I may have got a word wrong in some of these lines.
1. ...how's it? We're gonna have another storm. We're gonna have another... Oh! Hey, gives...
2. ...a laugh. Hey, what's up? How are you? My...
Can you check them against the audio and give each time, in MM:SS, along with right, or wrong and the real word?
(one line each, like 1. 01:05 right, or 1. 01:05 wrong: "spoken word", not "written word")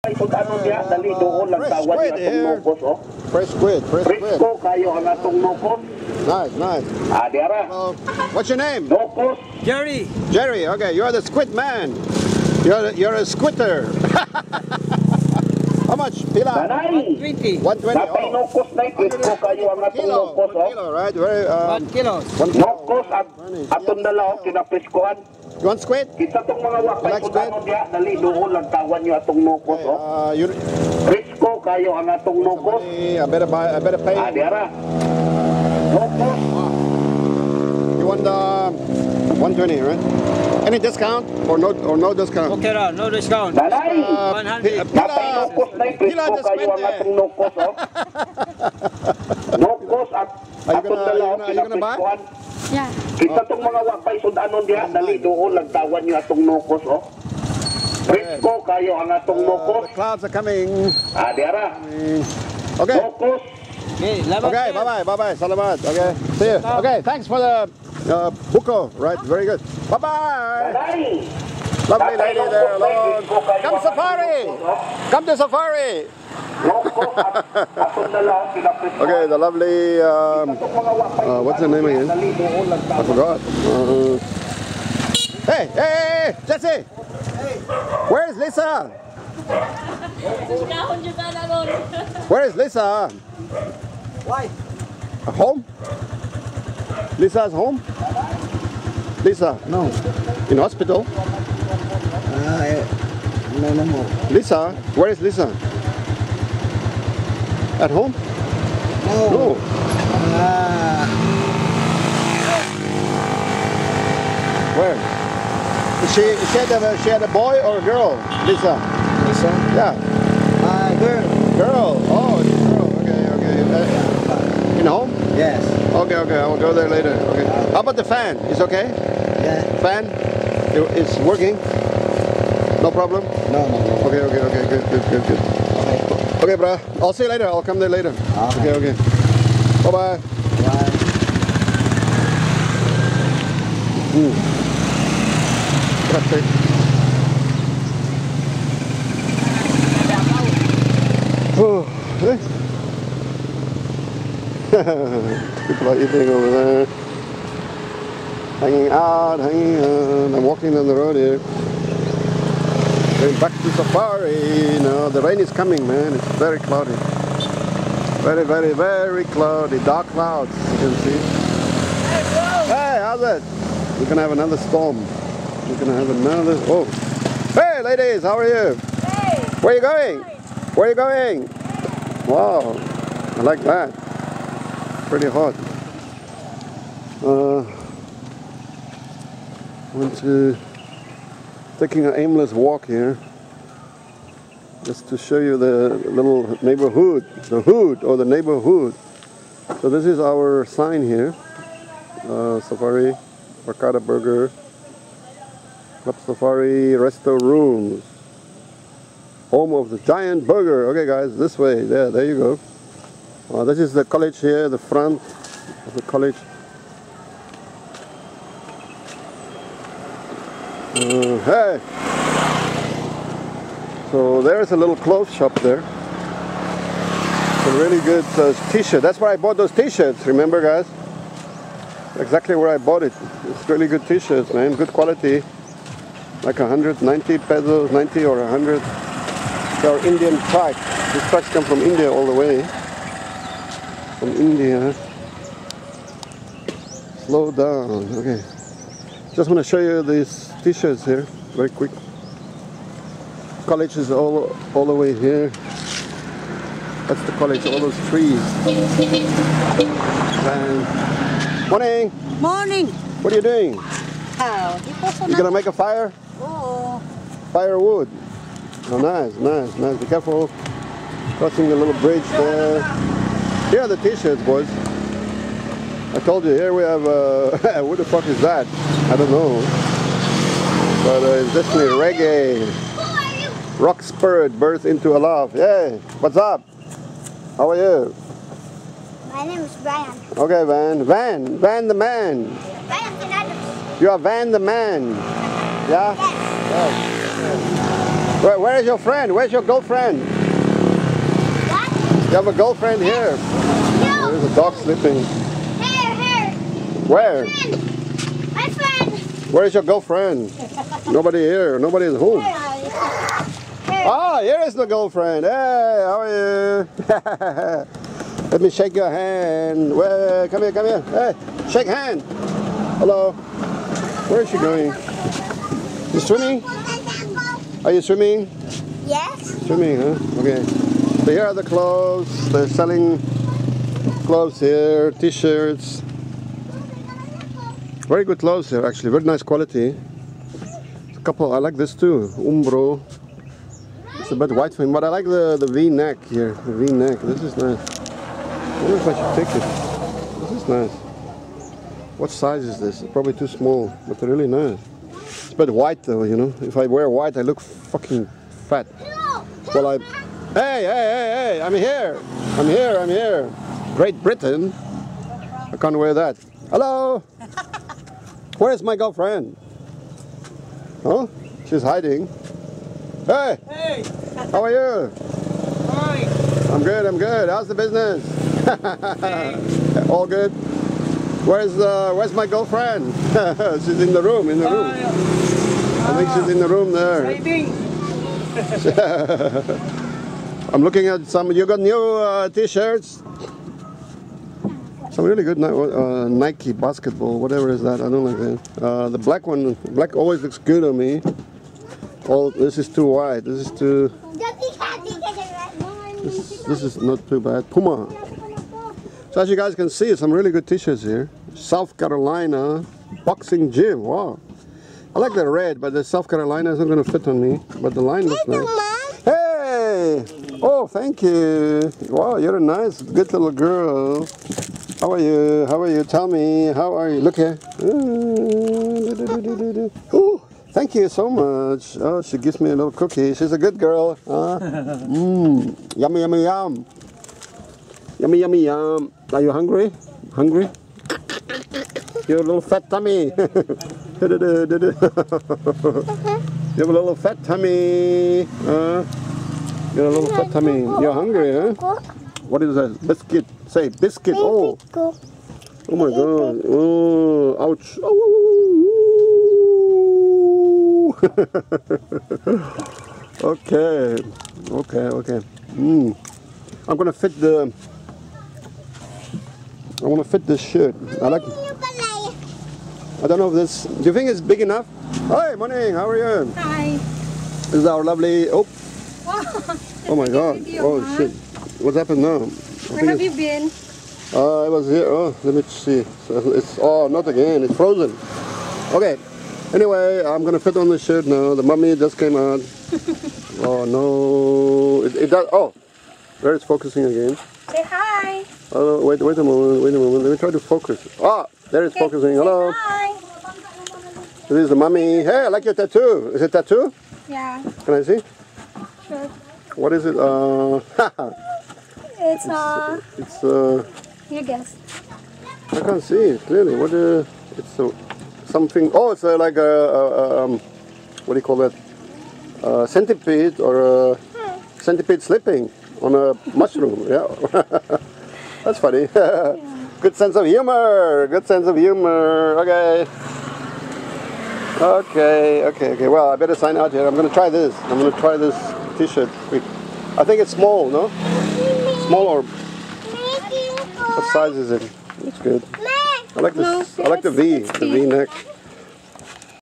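1. 02:52 wrong: "ladies", not "gives"
2. 04:45 right.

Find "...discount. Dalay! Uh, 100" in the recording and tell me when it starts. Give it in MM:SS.
00:43.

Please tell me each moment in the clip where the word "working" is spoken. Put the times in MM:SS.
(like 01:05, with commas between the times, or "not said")
02:11.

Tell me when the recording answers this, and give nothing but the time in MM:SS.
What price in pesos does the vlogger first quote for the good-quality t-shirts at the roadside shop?
03:56.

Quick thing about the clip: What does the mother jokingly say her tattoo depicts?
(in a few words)
centipede slipping on a mushroom.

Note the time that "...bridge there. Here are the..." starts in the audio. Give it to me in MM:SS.
04:32.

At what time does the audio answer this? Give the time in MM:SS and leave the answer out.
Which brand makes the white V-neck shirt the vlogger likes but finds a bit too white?
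05:42.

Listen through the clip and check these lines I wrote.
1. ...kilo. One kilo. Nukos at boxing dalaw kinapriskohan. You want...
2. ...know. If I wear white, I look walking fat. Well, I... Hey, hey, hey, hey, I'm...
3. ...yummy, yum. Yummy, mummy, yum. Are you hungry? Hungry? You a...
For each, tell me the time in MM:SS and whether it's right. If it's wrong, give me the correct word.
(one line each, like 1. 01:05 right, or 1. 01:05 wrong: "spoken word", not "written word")
1. 00:21 wrong: "atong", not "boxing"
2. 05:56 wrong: "fucking", not "walking"
3. 07:16 wrong: "yummy", not "mummy".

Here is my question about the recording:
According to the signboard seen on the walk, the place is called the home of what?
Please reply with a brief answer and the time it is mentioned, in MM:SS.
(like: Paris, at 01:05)
the giant burger, at 03:29.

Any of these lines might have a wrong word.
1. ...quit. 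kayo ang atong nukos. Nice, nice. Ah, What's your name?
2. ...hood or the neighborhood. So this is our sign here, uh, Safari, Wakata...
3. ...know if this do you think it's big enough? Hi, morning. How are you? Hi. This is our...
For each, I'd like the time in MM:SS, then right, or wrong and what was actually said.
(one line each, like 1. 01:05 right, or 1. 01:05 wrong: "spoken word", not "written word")
1. 00:04 right
2. 03:17 right
3. 07:53 right.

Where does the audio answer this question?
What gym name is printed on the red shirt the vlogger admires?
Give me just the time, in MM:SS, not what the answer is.
06:51.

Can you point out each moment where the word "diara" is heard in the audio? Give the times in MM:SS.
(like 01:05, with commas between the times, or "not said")
00:34, 01:01.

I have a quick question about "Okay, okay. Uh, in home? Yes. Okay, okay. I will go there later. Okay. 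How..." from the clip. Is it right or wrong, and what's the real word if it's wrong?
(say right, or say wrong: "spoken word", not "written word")
right.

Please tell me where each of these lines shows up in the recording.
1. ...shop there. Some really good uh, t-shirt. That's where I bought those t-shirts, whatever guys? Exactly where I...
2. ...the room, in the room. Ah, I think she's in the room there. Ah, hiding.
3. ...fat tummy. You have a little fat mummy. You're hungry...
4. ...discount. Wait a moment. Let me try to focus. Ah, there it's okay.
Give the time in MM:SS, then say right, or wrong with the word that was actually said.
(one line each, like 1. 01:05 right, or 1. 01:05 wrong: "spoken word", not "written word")
1. 03:45 wrong: "remember", not "whatever"
2. 06:24 right
3. 07:27 wrong: "tummy", not "mummy"
4. 08:19 wrong: "moment", not "discount".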